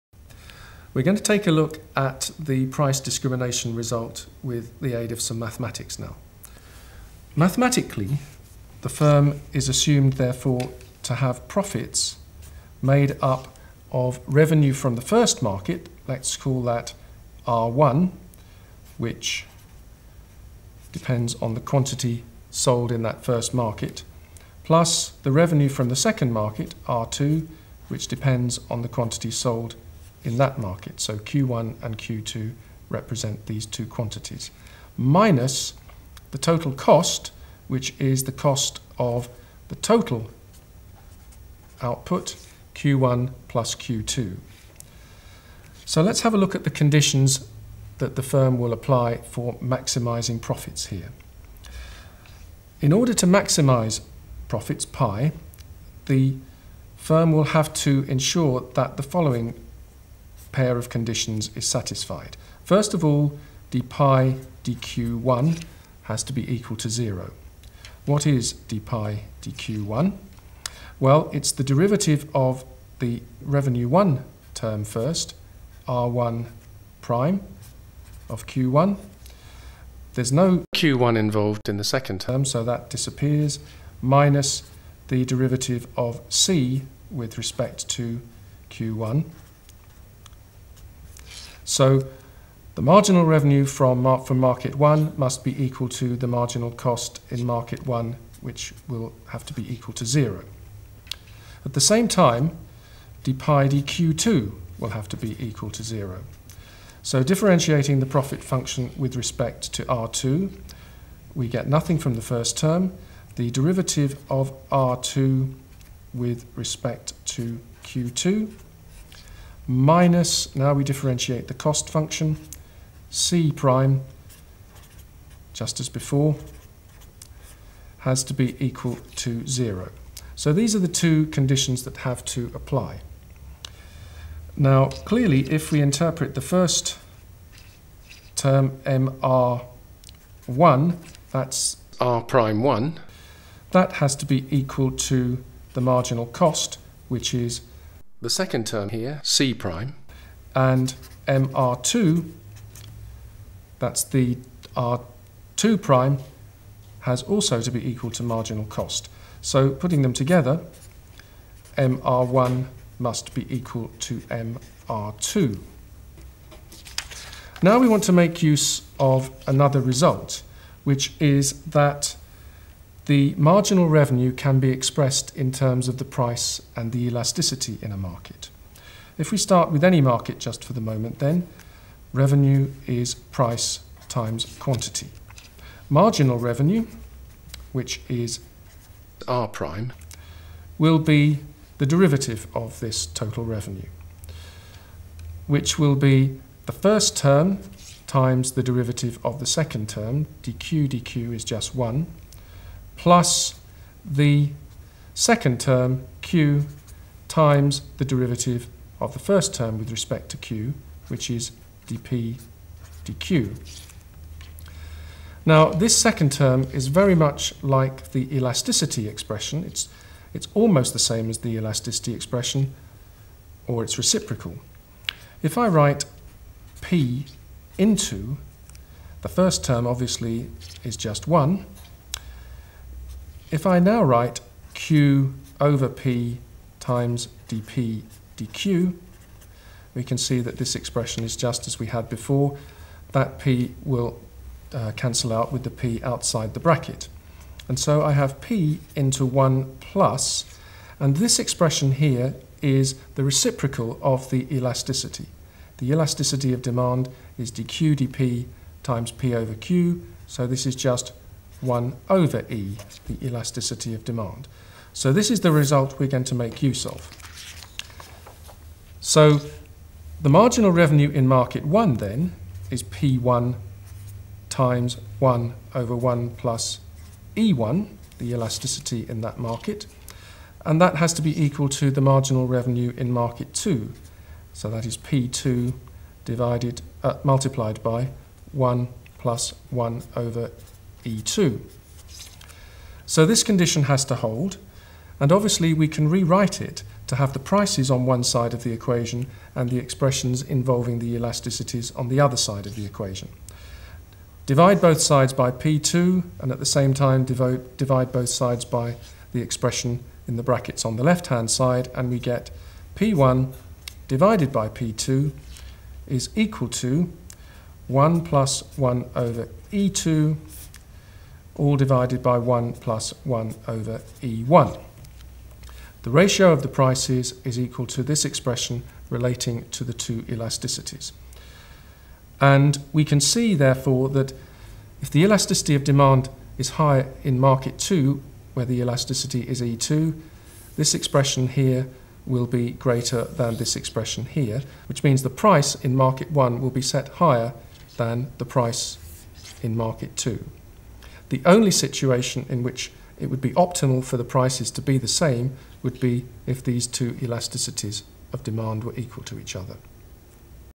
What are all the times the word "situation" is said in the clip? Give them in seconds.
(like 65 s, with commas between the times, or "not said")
351 s.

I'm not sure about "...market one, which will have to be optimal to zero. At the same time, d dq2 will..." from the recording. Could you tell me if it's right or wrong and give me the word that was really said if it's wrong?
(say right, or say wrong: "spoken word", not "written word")
wrong: "equal", not "optimal".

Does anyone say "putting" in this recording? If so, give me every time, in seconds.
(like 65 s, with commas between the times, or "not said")
159 s.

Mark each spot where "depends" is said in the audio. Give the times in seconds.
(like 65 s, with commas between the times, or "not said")
20 s, 28 s.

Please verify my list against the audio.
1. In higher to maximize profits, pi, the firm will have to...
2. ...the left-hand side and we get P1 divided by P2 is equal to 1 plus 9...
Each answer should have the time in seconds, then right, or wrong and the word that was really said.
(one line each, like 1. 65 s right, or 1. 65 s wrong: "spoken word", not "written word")
1. 52 s wrong: "order", not "higher"
2. 310 s wrong: "1", not "9".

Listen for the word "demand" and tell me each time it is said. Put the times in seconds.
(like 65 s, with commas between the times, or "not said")
256 s, 264 s, 335 s, 358 s.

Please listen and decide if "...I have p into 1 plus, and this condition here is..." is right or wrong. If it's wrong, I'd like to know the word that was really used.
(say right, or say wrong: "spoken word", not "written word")
wrong: "expression", not "condition".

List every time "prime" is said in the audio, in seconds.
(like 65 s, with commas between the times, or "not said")
77 s, 123 s, 142 s, 149 s, 155 s, 189 s.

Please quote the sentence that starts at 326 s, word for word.
The ratio of the prices is equal to this expression relating to the two elasticities.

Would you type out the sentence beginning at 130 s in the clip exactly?
So these are the two conditions that have to apply.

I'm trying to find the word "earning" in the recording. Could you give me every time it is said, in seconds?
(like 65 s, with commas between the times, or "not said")
not said.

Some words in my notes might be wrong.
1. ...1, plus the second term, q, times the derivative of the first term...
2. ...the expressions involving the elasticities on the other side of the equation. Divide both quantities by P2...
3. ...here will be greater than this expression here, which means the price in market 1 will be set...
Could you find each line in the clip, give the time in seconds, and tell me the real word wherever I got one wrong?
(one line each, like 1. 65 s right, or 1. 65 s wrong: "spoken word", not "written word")
1. 201 s right
2. 299 s wrong: "sides", not "quantities"
3. 341 s right.